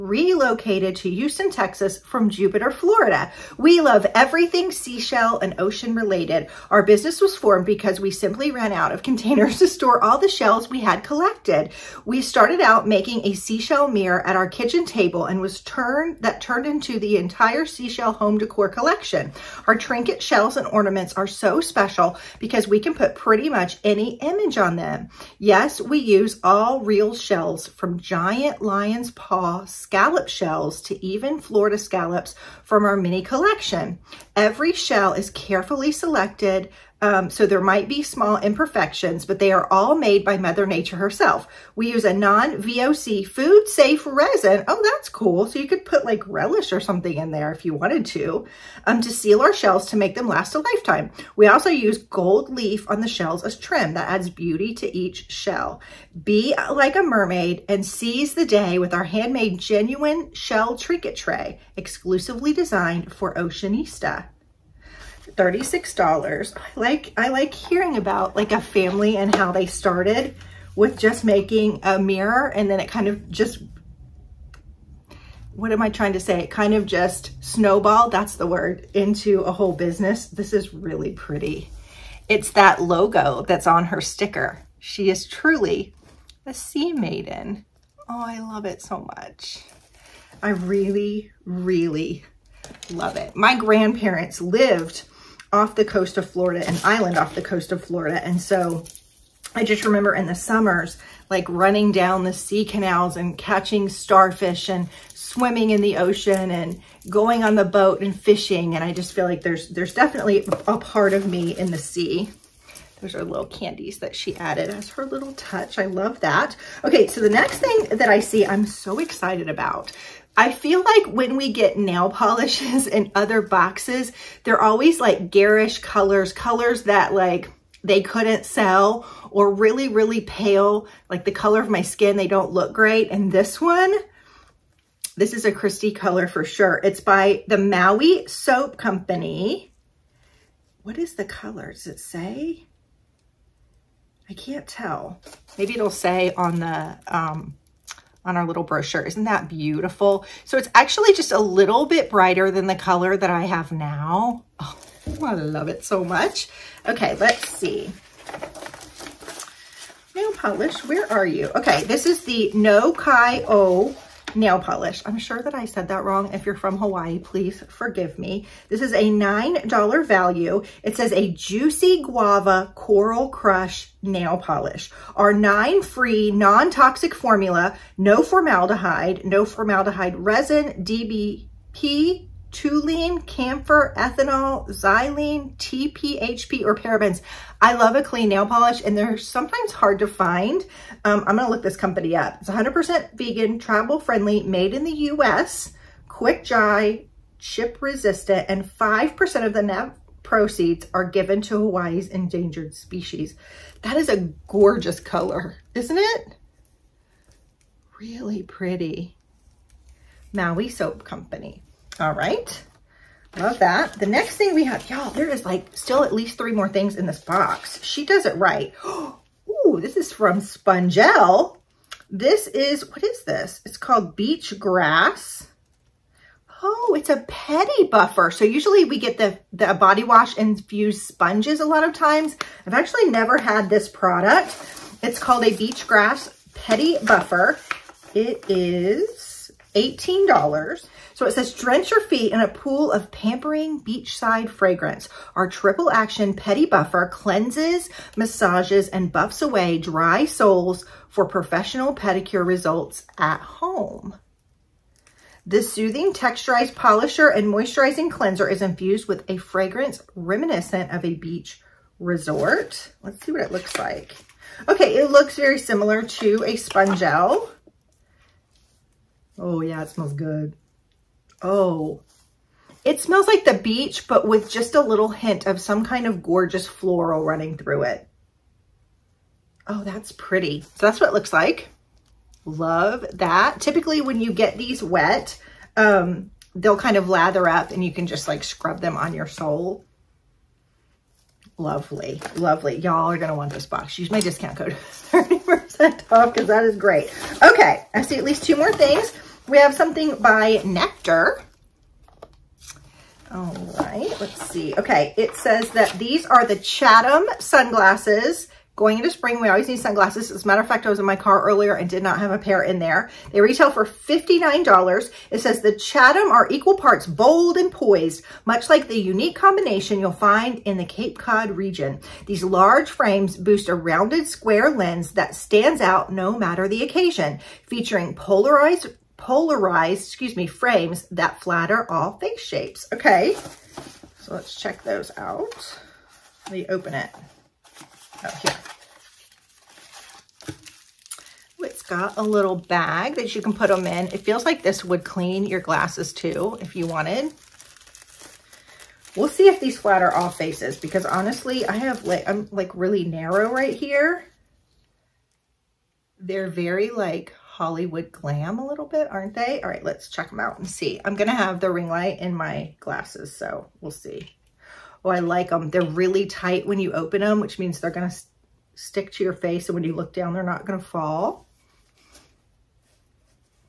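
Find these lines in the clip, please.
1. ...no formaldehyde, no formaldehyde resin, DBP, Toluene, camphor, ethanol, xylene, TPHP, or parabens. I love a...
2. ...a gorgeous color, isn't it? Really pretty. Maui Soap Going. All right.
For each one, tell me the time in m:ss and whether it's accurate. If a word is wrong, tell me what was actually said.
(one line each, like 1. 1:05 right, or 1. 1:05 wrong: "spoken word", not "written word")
1. 2:57 right
2. 3:24 wrong: "Company", not "Going".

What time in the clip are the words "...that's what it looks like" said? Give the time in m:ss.
4:40.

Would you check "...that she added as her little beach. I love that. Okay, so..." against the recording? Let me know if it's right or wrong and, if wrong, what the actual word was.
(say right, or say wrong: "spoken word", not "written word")
wrong: "touch", not "beach".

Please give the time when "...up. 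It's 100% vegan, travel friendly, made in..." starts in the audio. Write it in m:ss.
3:12.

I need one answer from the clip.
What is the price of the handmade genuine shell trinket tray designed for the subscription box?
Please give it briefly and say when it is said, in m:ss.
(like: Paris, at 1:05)
$36, at 1:05.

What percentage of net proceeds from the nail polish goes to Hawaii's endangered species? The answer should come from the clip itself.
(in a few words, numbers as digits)
5%.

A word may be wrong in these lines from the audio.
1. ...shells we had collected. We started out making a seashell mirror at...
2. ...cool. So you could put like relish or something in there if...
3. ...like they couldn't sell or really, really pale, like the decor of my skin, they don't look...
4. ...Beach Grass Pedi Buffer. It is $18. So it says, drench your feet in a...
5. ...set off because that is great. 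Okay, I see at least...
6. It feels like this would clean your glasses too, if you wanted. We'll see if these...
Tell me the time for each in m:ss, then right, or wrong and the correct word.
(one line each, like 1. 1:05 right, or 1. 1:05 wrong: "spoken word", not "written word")
1. 0:10 right
2. 0:45 right
3. 2:07 wrong: "color", not "decor"
4. 3:55 right
5. 4:55 right
6. 5:44 right.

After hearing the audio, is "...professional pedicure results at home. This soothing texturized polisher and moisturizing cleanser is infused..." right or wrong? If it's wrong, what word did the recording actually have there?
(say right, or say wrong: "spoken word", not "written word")
right.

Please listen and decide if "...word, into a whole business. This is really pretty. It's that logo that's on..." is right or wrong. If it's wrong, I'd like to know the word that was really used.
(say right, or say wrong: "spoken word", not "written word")
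right.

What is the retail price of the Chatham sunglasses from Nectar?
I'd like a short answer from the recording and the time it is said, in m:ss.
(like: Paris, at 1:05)
$59, at 5:13.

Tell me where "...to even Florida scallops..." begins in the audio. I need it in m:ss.
0:30.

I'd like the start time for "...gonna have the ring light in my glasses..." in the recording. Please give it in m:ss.
6:01.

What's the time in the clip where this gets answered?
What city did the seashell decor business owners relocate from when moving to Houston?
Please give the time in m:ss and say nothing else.
0:02.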